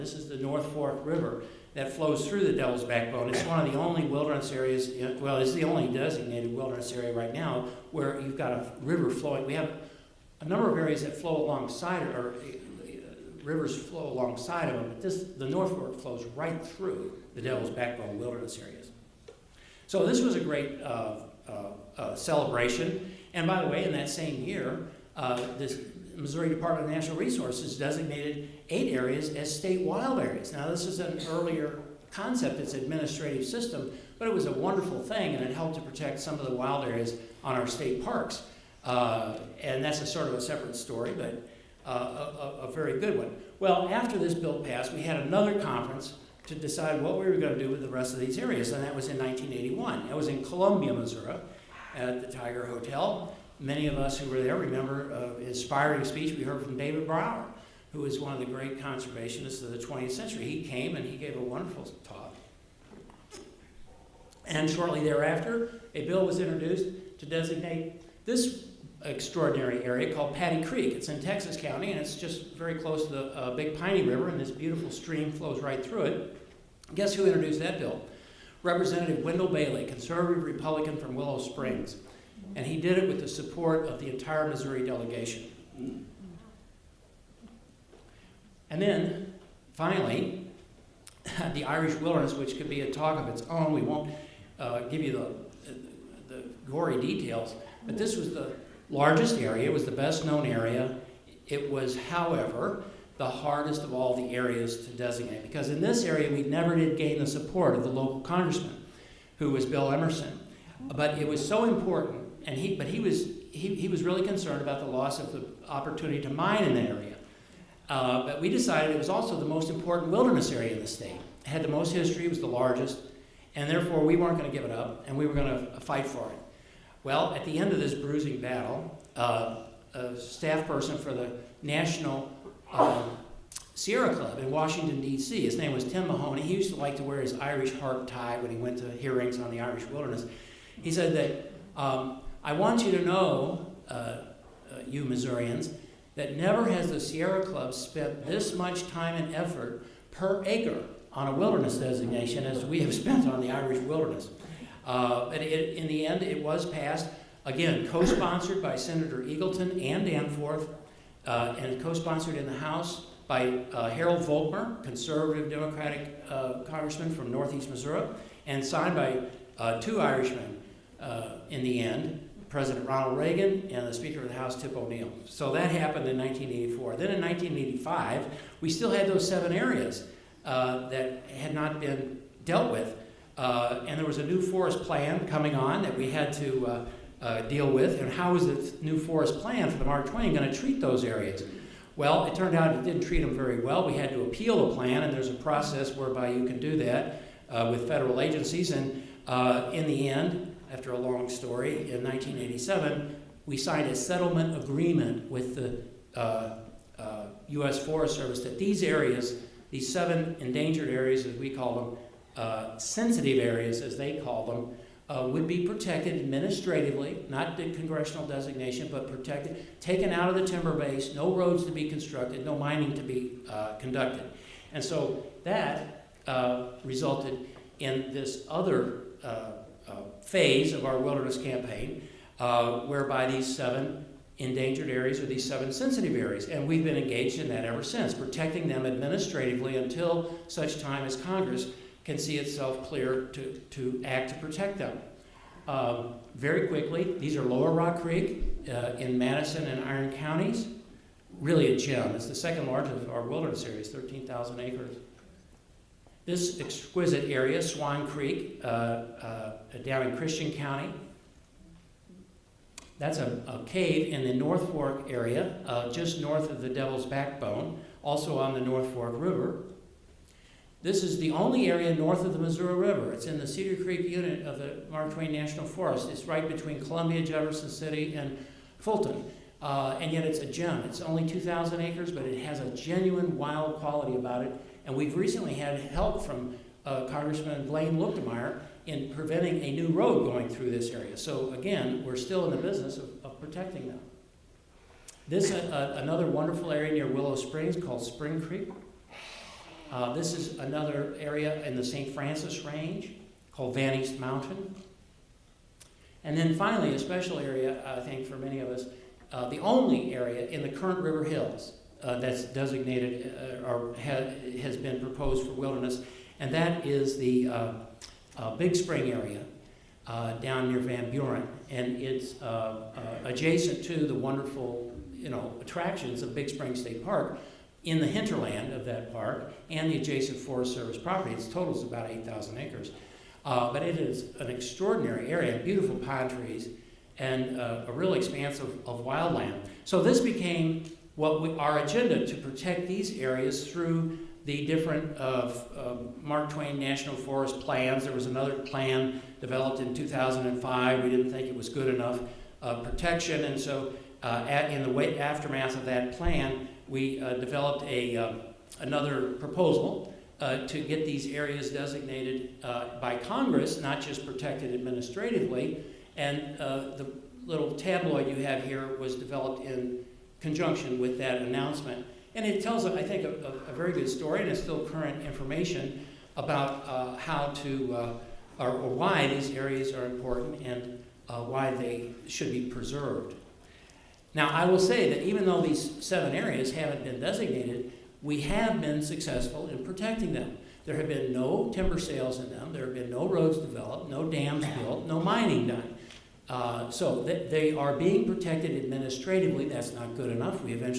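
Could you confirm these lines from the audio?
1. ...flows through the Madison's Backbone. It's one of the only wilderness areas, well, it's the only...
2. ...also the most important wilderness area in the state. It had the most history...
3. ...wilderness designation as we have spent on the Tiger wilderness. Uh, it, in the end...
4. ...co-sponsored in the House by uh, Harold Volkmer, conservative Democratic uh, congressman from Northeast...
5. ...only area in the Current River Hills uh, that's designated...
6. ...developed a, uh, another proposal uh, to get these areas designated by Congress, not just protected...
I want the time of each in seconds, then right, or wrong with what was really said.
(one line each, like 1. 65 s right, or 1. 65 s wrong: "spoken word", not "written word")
1. 1 s wrong: "Devil", not "Madison"
2. 119 s right
3. 151 s wrong: "Irish", not "Tiger"
4. 161 s right
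5. 309 s right
6. 357 s right.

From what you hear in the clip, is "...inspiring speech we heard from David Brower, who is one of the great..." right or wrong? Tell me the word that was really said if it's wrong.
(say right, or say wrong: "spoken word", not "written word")
right.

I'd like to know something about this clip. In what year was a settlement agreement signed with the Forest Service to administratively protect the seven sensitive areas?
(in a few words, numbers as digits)
1987.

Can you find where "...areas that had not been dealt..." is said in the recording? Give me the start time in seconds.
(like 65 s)
179 s.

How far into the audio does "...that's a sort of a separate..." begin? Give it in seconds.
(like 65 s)
39 s.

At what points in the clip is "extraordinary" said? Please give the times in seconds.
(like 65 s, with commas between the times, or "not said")
69 s, 334 s.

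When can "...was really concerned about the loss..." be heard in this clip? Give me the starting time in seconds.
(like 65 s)
113 s.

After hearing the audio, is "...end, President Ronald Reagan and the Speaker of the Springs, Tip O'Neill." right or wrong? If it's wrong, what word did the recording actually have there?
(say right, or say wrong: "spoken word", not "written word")
wrong: "House", not "Springs".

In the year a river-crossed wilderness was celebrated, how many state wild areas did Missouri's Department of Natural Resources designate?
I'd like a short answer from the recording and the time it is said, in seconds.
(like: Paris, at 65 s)
8, at 28 s.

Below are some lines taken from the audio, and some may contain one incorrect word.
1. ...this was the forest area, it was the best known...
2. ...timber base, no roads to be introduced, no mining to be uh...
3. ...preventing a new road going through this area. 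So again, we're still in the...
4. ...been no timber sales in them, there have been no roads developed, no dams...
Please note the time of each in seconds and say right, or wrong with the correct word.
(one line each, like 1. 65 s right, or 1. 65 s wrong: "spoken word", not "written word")
1. 97 s wrong: "largest", not "forest"
2. 220 s wrong: "constructed", not "introduced"
3. 289 s right
4. 391 s right.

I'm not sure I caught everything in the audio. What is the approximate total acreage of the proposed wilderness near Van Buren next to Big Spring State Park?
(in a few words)
8,000 acres.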